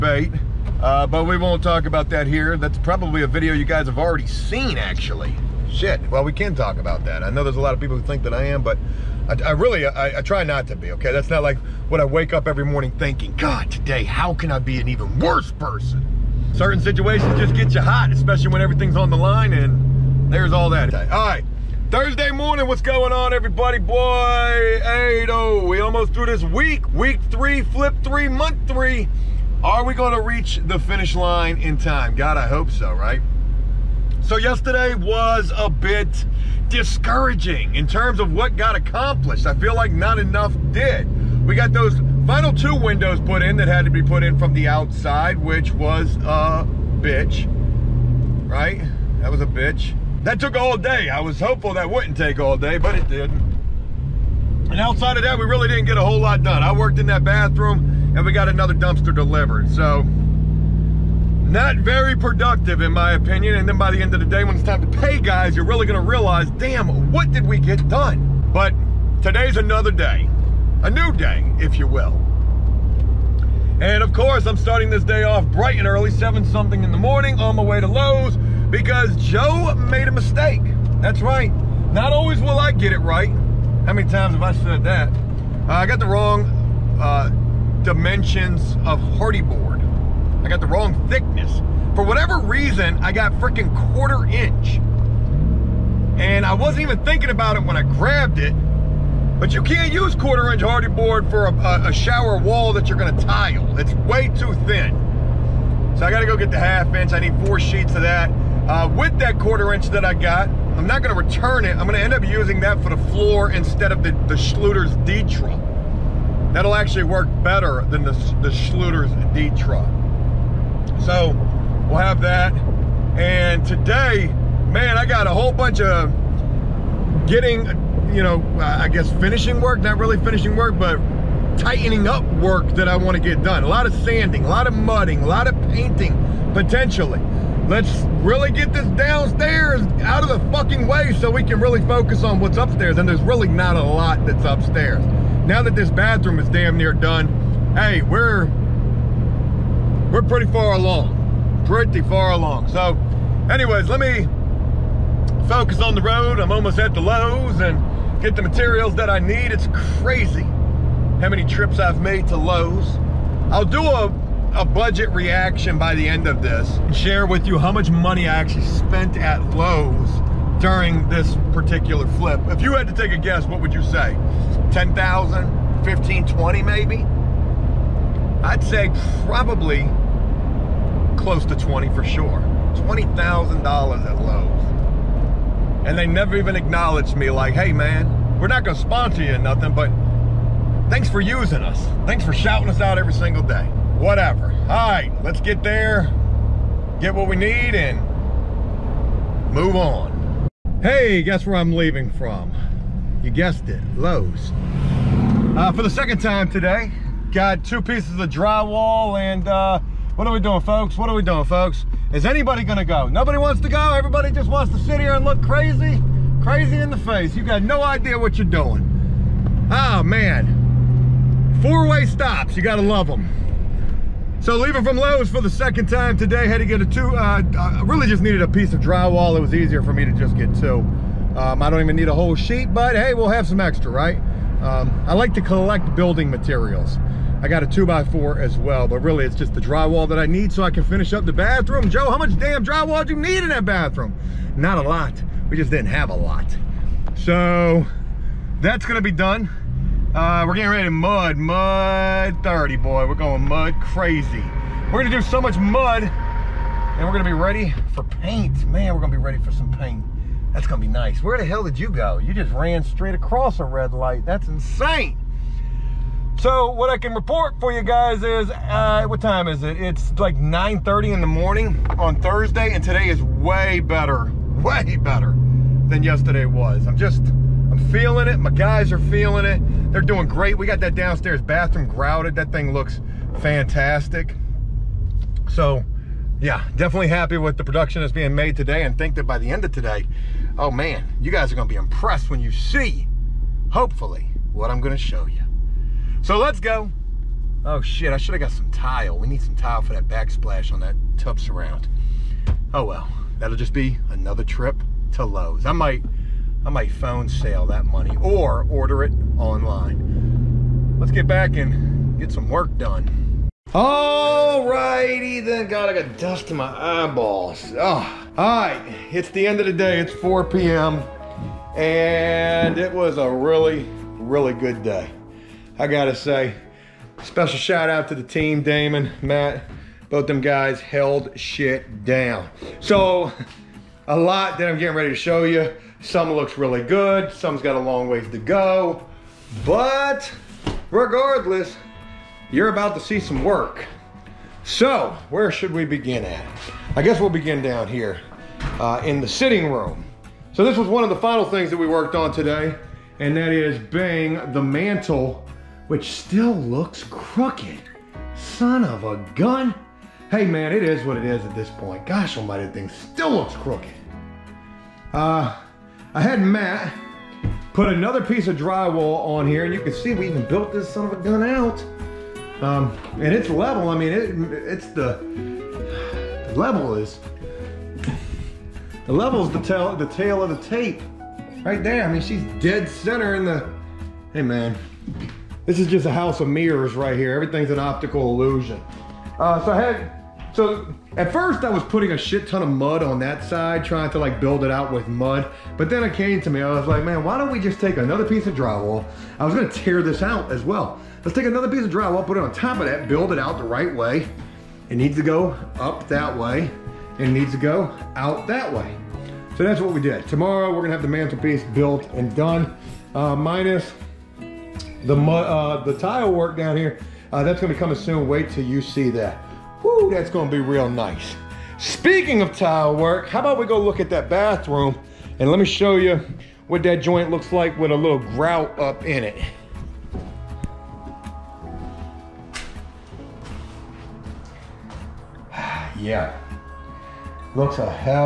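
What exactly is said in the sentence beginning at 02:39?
It's crazy how many trips I've made to Lowe's.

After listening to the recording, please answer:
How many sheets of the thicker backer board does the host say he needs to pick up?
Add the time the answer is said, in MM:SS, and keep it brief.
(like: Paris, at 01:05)
4, at 01:47.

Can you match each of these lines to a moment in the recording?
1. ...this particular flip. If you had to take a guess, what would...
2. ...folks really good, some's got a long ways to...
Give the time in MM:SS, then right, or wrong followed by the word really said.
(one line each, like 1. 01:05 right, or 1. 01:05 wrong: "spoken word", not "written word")
1. 02:51 right
2. 05:36 wrong: "looks", not "folks".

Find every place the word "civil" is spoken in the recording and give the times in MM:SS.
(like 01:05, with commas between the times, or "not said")
not said.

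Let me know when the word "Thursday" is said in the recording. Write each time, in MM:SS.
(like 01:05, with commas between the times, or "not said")
00:21, 04:32.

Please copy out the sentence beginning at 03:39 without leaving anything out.
Oh man, four-way stops, you gotta love them.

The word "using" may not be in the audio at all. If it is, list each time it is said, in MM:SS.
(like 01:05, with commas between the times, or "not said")
01:52, 03:11.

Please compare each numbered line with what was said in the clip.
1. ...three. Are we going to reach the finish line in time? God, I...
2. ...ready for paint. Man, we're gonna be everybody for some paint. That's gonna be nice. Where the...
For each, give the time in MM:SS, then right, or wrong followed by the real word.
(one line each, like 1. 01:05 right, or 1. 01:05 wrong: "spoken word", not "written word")
1. 00:28 right
2. 04:17 wrong: "ready", not "everybody".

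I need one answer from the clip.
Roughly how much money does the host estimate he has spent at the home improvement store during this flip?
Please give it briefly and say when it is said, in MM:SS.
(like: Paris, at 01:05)
$20,000, at 03:02.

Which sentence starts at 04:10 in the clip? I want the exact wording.
Uh, we're getting ready to mud, mud 30, boy.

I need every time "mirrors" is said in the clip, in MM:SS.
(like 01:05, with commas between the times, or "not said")
06:26.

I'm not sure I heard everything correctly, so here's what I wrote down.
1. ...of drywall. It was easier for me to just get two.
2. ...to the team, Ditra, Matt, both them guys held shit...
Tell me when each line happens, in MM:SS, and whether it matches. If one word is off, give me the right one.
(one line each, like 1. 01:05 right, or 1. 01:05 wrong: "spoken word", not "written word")
1. 03:48 right
2. 05:28 wrong: "Damon", not "Ditra".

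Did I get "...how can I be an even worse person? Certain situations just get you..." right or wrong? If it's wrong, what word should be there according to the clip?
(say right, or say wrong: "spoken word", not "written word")
right.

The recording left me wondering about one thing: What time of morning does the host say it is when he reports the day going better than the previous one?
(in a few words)
9:30.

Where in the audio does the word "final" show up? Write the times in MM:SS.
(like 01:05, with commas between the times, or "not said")
00:42, 05:51.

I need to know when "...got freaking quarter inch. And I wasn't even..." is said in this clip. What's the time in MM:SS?
01:33.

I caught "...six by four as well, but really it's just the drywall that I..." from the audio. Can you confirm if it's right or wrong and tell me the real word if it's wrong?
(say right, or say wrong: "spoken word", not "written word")
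wrong: "two", not "six".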